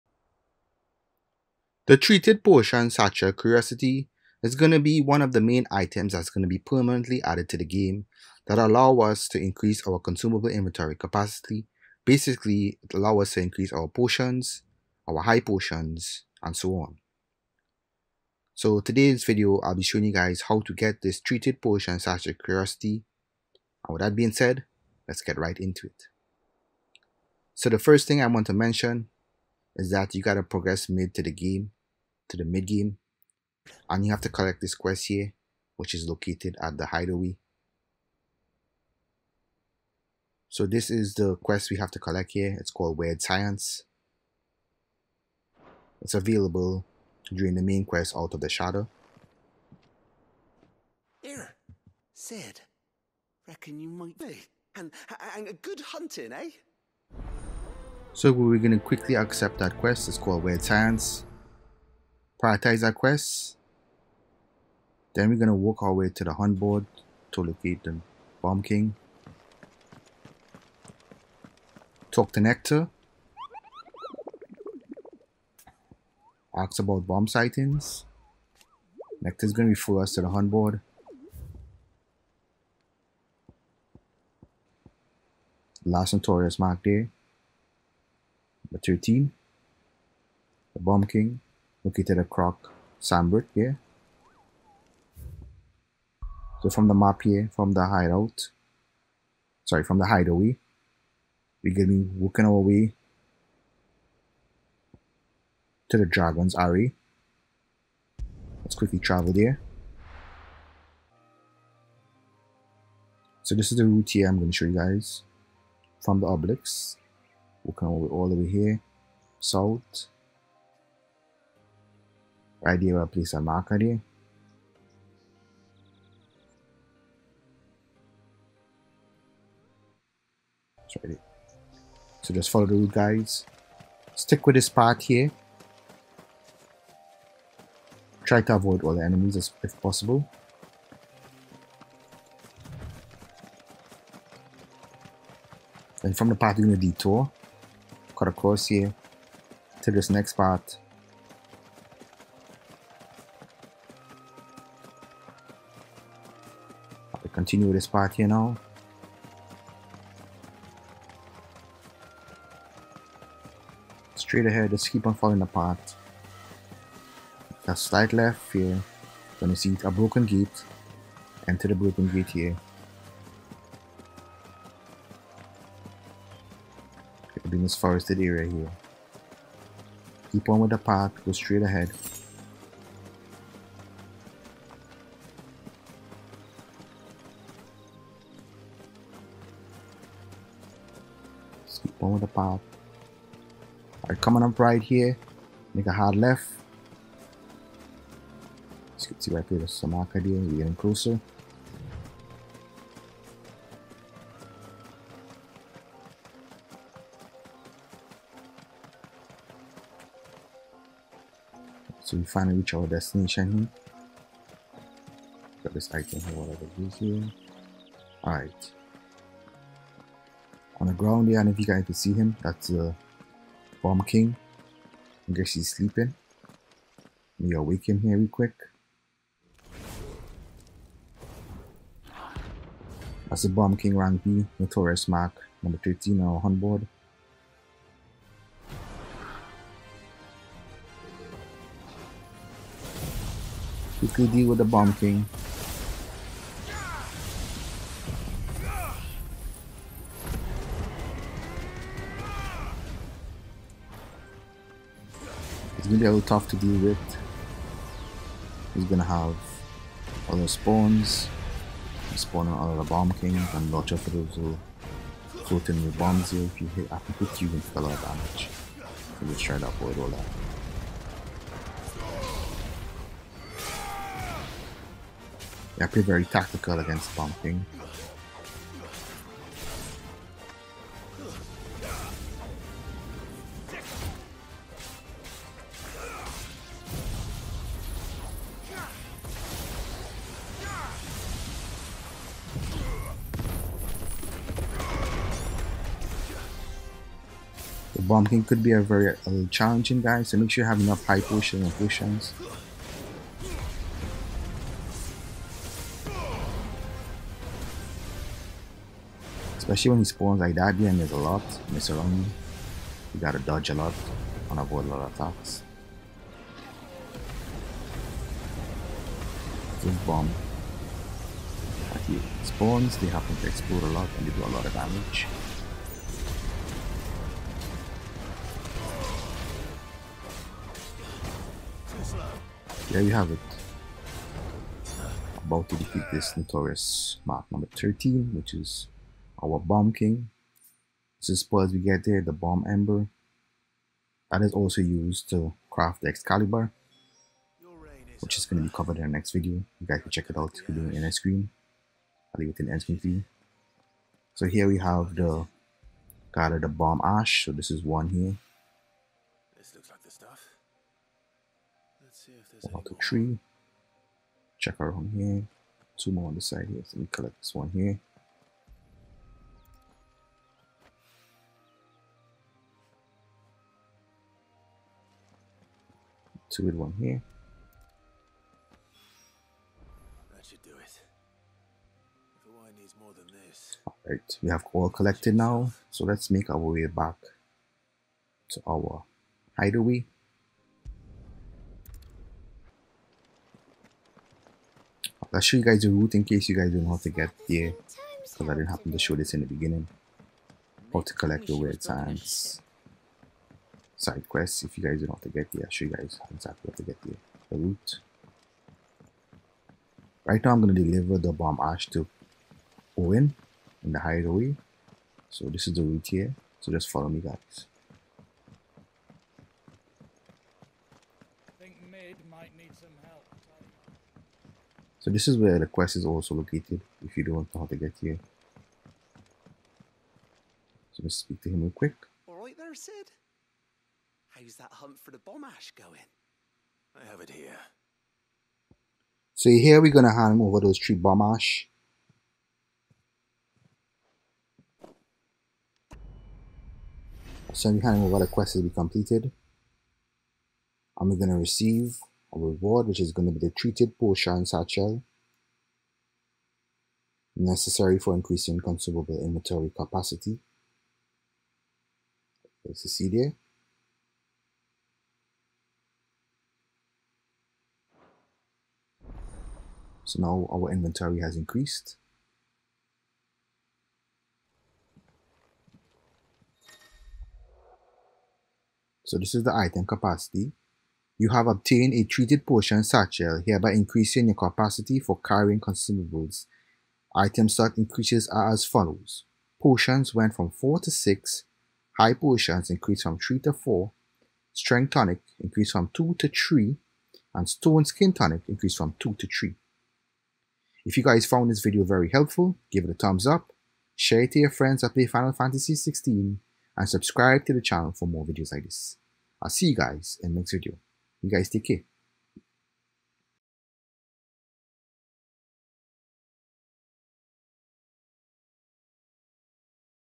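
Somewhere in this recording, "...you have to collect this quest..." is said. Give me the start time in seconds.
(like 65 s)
34 s.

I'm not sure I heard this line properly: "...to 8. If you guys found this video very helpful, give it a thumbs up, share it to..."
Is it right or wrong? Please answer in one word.
wrong.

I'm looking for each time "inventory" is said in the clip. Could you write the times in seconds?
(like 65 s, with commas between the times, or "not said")
10 s, 459 s, 470 s.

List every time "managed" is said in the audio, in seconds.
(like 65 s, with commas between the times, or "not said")
not said.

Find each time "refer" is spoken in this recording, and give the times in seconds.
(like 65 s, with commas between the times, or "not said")
79 s.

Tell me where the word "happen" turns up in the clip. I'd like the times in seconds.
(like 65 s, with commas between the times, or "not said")
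323 s, 398 s.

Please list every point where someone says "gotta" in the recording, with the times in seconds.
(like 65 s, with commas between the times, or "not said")
30 s, 313 s.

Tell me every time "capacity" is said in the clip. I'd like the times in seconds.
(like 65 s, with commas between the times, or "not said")
10 s, 459 s, 479 s, 484 s.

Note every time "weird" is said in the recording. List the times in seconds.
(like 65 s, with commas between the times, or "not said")
42 s, 60 s, 401 s.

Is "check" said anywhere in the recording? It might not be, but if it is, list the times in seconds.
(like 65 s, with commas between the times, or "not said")
350 s, 364 s.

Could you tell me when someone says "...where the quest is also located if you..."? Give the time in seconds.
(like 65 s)
425 s.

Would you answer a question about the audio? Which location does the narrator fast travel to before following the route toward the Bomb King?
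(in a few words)
Dragon's Aery.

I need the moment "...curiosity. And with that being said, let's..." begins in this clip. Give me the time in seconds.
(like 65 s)
22 s.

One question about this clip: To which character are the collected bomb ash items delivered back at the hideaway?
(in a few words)
Owen.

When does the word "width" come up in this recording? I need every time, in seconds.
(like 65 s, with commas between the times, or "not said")
not said.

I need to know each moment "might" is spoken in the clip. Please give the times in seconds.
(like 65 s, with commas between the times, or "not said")
53 s, 422 s.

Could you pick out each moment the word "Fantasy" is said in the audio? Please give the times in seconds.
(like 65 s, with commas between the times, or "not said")
505 s.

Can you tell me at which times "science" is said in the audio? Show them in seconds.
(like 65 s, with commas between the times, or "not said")
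43 s, 60 s, 401 s.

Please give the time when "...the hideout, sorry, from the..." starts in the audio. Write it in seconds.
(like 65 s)
97 s.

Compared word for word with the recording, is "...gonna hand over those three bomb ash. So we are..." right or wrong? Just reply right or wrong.
right.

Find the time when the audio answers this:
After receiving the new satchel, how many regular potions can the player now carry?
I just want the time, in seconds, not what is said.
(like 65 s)
490 s.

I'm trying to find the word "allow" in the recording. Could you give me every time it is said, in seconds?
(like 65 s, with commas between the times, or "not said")
8 s, 12 s.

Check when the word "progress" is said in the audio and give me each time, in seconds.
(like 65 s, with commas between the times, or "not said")
30 s.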